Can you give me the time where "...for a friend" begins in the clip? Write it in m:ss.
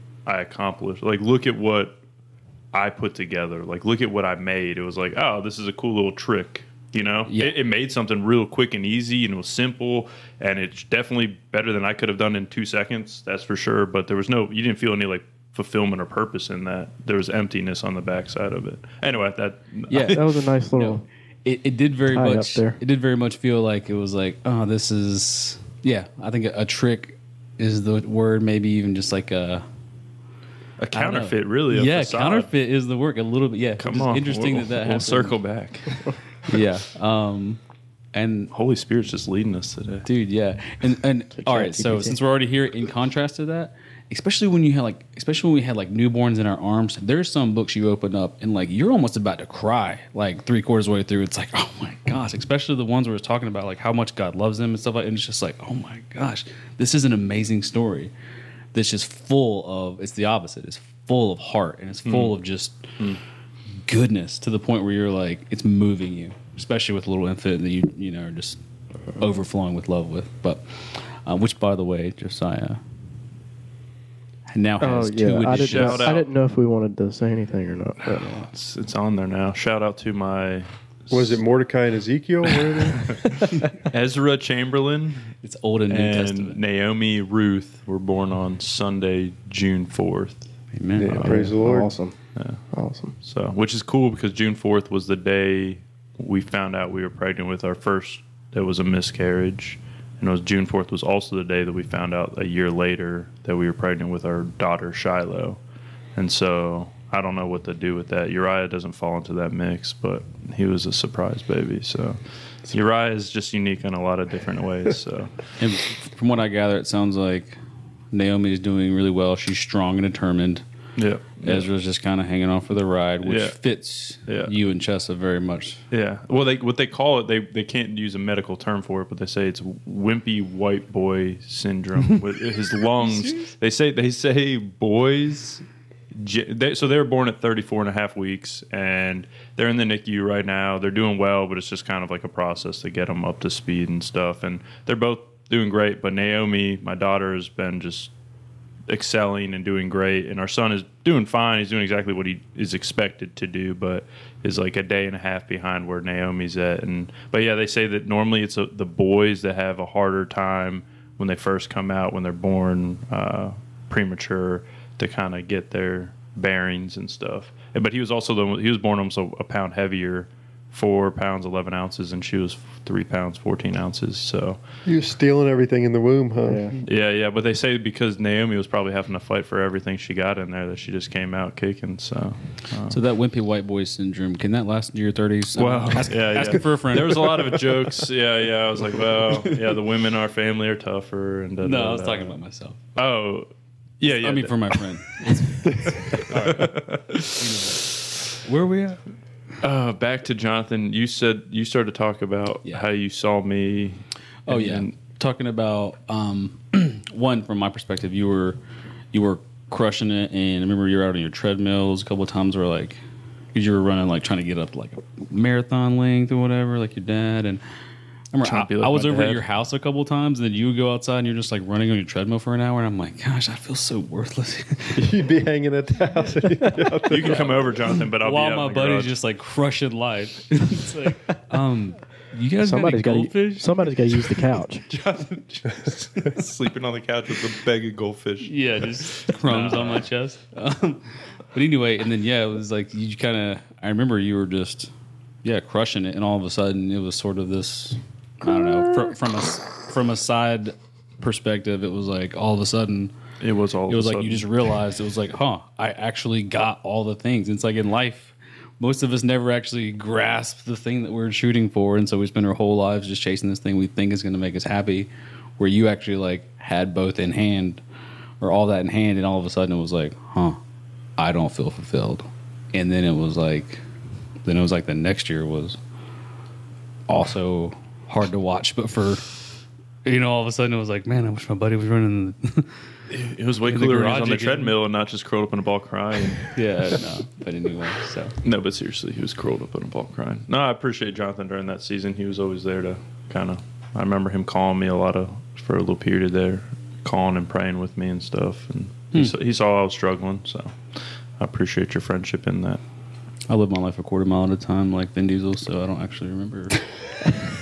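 3:06.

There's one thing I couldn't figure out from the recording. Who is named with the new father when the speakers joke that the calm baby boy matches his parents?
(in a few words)
Chessa.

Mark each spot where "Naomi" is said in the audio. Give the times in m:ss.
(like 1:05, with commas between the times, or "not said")
1:26, 1:58, 2:26, 2:36, 2:58.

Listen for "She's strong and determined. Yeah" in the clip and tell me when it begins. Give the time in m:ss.
1:59.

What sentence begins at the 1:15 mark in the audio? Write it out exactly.
two I didn't, know, I didn't know if we wanted to say anything or not.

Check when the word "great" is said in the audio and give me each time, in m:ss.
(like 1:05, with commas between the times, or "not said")
2:25, 2:29.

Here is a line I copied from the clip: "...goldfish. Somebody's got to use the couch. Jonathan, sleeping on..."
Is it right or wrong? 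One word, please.
right.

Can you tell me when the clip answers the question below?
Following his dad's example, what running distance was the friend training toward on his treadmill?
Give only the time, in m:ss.
3:35.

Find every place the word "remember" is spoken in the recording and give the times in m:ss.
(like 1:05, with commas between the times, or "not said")
3:30, 3:38, 4:03, 4:53, 5:06.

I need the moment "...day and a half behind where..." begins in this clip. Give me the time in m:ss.
2:34.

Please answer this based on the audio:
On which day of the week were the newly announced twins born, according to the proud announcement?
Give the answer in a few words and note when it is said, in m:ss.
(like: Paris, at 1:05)
Sunday, at 1:28.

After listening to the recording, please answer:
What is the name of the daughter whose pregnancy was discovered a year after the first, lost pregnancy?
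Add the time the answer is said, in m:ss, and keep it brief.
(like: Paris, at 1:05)
Shiloh, at 1:44.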